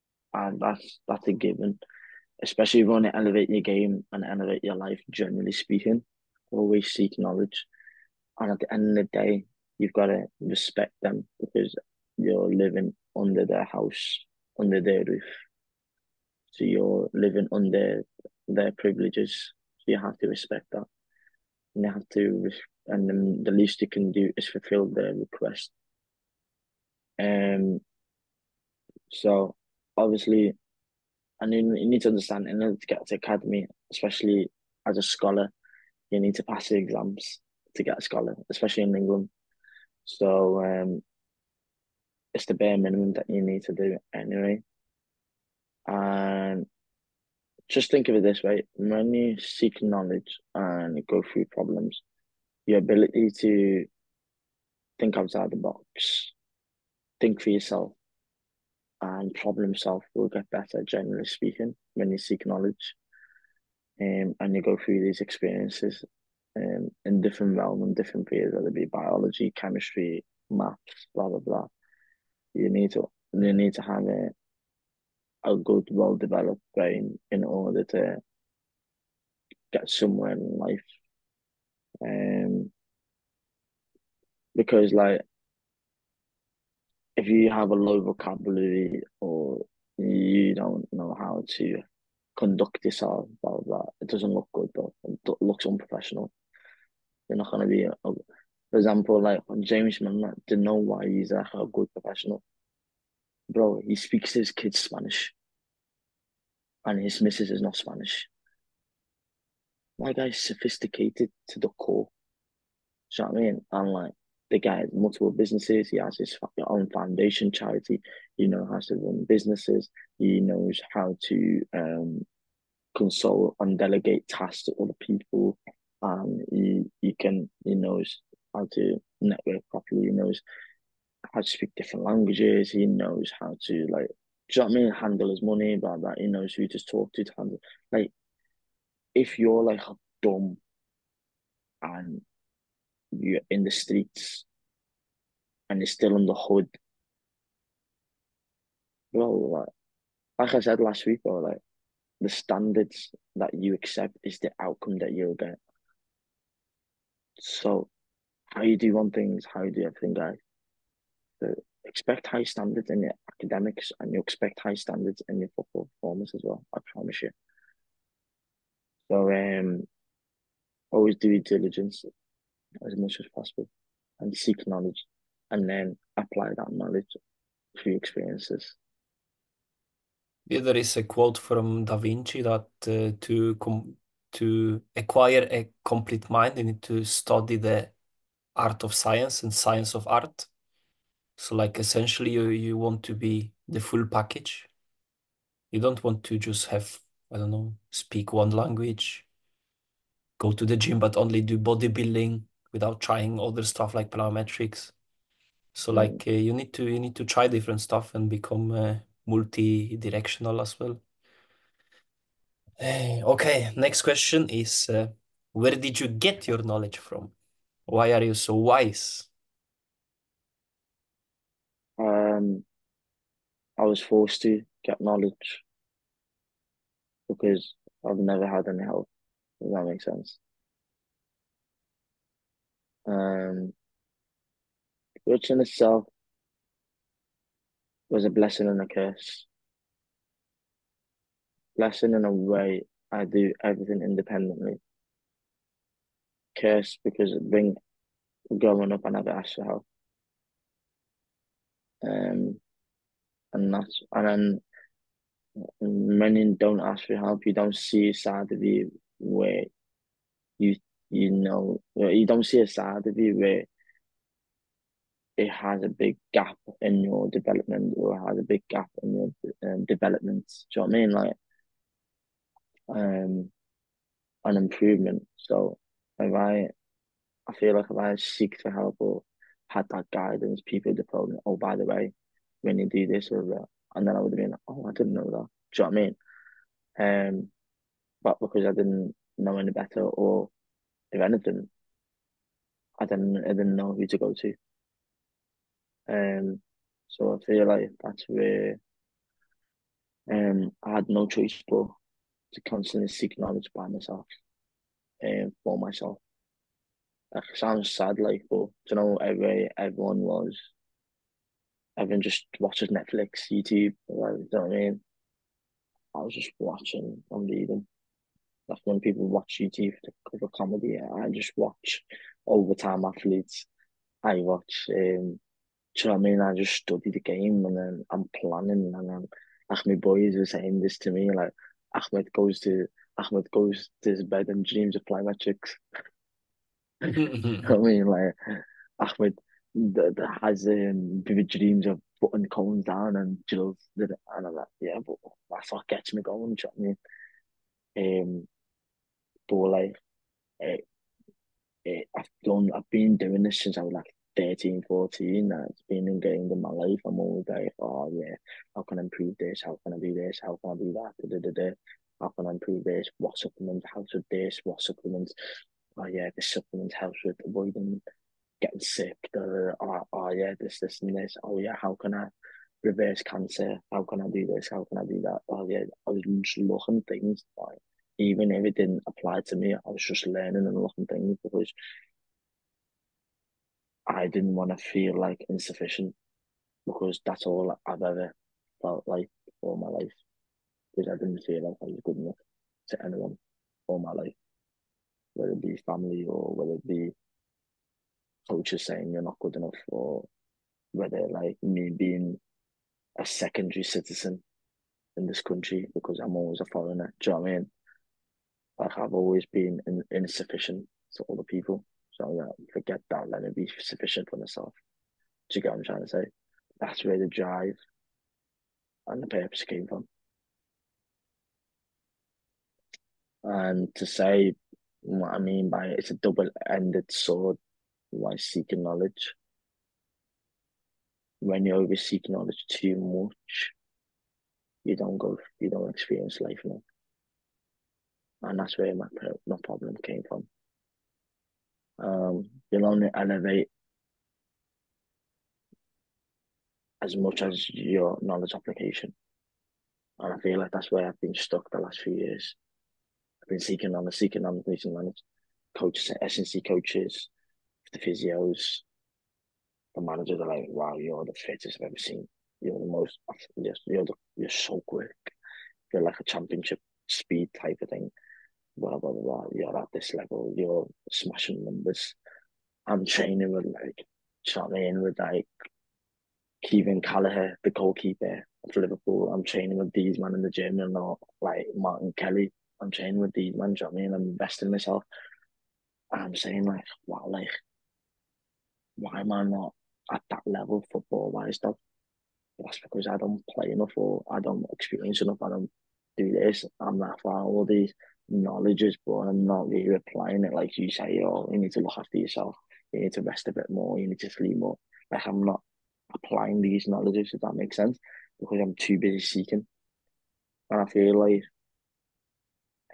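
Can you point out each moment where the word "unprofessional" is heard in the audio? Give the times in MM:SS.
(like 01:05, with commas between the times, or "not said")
01:35.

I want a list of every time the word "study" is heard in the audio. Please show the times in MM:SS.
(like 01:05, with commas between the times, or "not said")
03:07, 05:26.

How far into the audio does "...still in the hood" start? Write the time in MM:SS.
02:25.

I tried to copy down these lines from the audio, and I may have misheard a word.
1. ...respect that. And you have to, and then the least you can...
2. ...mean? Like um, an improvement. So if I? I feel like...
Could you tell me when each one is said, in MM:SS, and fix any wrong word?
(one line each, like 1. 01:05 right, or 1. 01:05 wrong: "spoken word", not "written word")
1. 00:20 right
2. 04:30 right.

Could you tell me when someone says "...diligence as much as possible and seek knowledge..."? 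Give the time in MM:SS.
02:51.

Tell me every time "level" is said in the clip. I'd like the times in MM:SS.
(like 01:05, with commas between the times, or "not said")
07:50, 08:10.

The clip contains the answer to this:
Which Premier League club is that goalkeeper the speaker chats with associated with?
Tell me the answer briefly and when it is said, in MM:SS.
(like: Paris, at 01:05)
Liverpool, at 07:58.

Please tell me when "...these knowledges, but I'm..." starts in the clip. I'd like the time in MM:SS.
08:17.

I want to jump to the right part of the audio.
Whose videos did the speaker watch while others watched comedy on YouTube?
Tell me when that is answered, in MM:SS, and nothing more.
05:22.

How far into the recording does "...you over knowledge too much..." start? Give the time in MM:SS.
07:11.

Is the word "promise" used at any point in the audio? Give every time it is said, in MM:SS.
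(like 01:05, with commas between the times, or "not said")
02:46.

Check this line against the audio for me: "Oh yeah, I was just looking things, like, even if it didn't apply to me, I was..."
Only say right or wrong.
right.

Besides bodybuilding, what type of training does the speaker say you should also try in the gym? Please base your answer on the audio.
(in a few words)
plyometrics.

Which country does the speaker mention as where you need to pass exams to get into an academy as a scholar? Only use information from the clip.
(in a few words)
England.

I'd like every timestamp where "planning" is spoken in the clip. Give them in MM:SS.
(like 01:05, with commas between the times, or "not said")
05:28.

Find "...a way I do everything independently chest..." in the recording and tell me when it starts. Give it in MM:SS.
04:02.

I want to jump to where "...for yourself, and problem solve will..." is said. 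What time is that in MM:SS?
00:57.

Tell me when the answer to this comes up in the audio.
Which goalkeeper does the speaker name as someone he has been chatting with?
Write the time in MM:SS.
07:56.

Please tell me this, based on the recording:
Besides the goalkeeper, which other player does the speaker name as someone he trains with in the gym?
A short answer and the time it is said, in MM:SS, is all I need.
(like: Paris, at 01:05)
Martin Kelly, at 08:01.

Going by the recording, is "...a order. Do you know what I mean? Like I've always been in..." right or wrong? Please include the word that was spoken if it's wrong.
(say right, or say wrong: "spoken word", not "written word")
wrong: "foreigner", not "order".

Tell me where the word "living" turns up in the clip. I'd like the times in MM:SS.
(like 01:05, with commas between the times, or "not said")
00:12, 00:17.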